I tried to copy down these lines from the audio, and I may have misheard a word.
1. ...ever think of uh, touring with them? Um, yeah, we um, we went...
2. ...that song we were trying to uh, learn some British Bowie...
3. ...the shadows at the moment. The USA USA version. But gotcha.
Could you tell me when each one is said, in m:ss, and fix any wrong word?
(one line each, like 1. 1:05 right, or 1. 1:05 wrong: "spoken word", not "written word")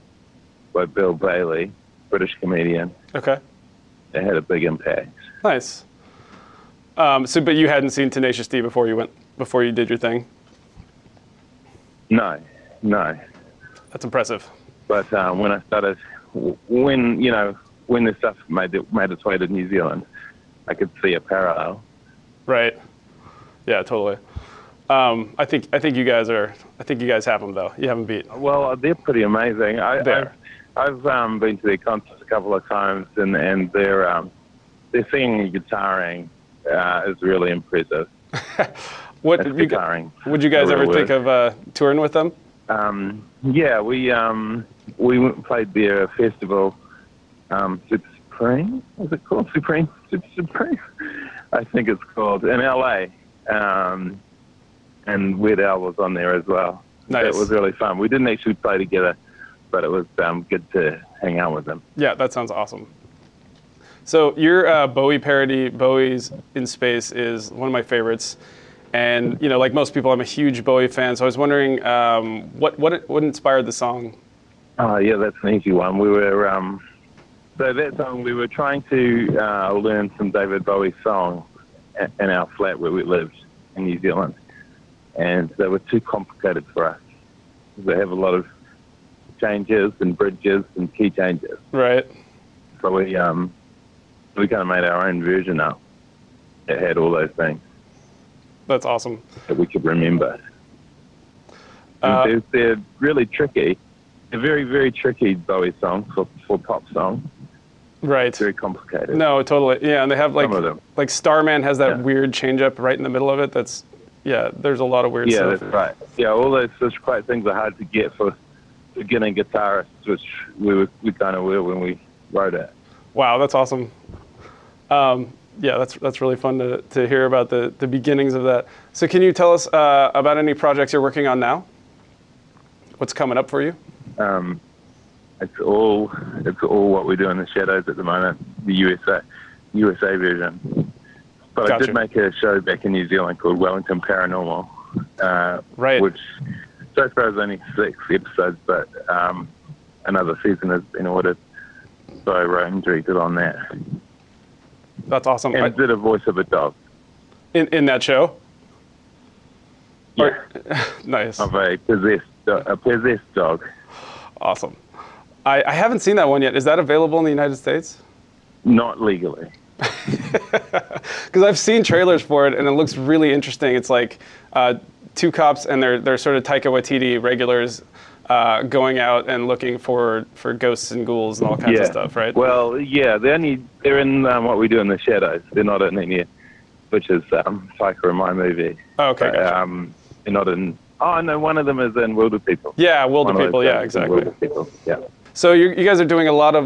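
1. 0:40 right
2. 1:17 wrong: "David", not "British"
3. 2:17 right.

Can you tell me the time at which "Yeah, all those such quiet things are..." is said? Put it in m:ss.
1:56.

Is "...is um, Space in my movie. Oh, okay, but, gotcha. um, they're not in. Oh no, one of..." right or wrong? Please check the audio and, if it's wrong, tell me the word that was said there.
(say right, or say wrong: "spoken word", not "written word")
wrong: "Psycho", not "Space".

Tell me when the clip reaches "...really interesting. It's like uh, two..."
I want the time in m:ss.
2:52.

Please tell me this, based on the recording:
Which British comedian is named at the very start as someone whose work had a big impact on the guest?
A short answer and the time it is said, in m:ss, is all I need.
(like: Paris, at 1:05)
Bill Bailey, at 0:00.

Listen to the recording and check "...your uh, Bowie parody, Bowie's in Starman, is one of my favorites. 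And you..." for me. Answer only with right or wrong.
wrong.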